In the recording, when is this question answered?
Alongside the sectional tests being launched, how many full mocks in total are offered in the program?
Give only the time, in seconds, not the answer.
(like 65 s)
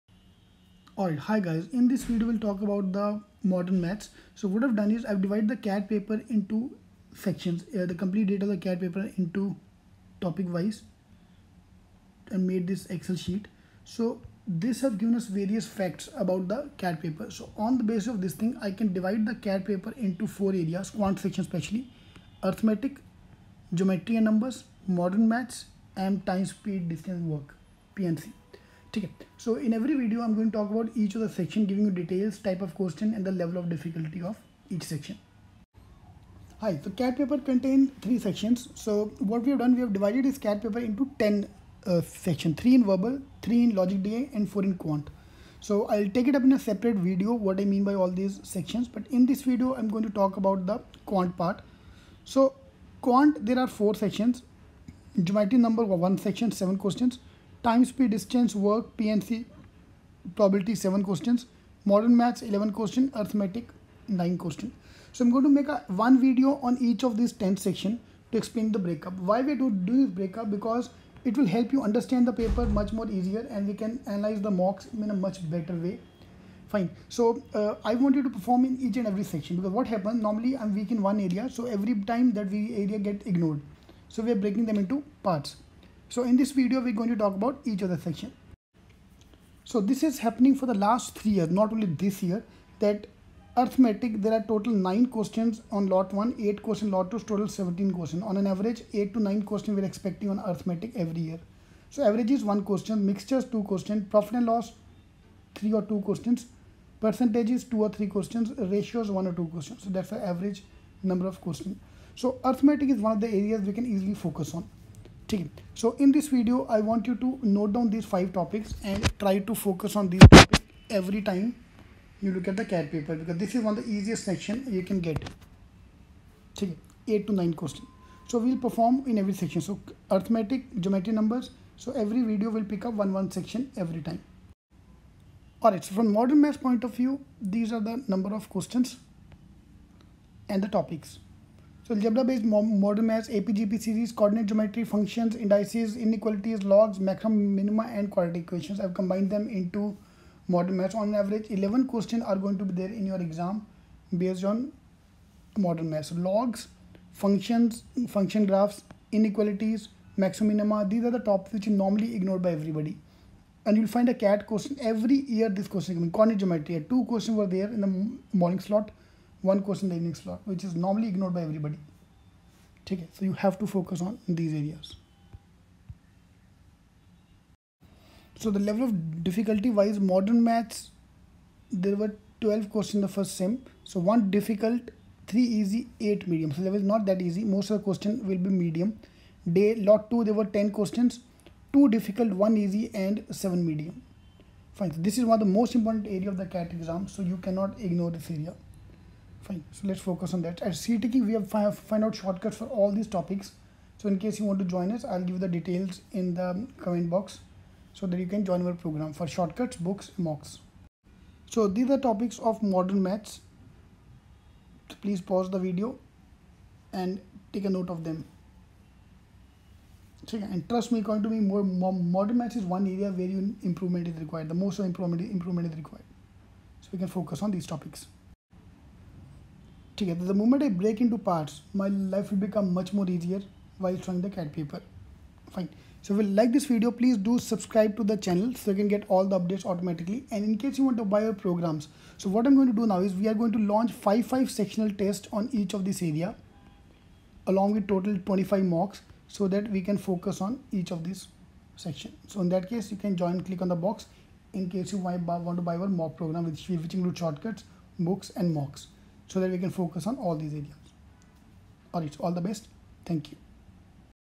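248 s.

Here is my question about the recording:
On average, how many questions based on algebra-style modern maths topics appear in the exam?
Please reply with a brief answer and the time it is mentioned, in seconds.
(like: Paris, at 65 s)
11, at 151 s.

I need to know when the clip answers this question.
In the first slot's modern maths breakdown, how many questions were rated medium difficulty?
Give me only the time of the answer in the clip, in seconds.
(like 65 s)
186 s.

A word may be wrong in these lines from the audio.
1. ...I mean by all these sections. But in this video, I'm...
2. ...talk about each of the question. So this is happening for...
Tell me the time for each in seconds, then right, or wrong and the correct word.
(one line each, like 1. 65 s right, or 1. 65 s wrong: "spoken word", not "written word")
1. 47 s right
2. 87 s wrong: "section", not "question".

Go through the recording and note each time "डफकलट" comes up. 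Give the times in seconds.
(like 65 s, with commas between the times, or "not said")
33 s.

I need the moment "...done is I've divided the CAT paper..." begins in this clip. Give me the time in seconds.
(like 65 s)
4 s.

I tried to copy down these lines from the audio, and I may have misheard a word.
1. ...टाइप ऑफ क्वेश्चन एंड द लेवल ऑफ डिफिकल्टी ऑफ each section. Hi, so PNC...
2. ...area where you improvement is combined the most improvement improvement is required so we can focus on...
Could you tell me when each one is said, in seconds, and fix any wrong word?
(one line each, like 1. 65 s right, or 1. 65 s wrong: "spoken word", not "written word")
1. 32 s wrong: "CAT", not "PNC"
2. 222 s wrong: "required", not "combined".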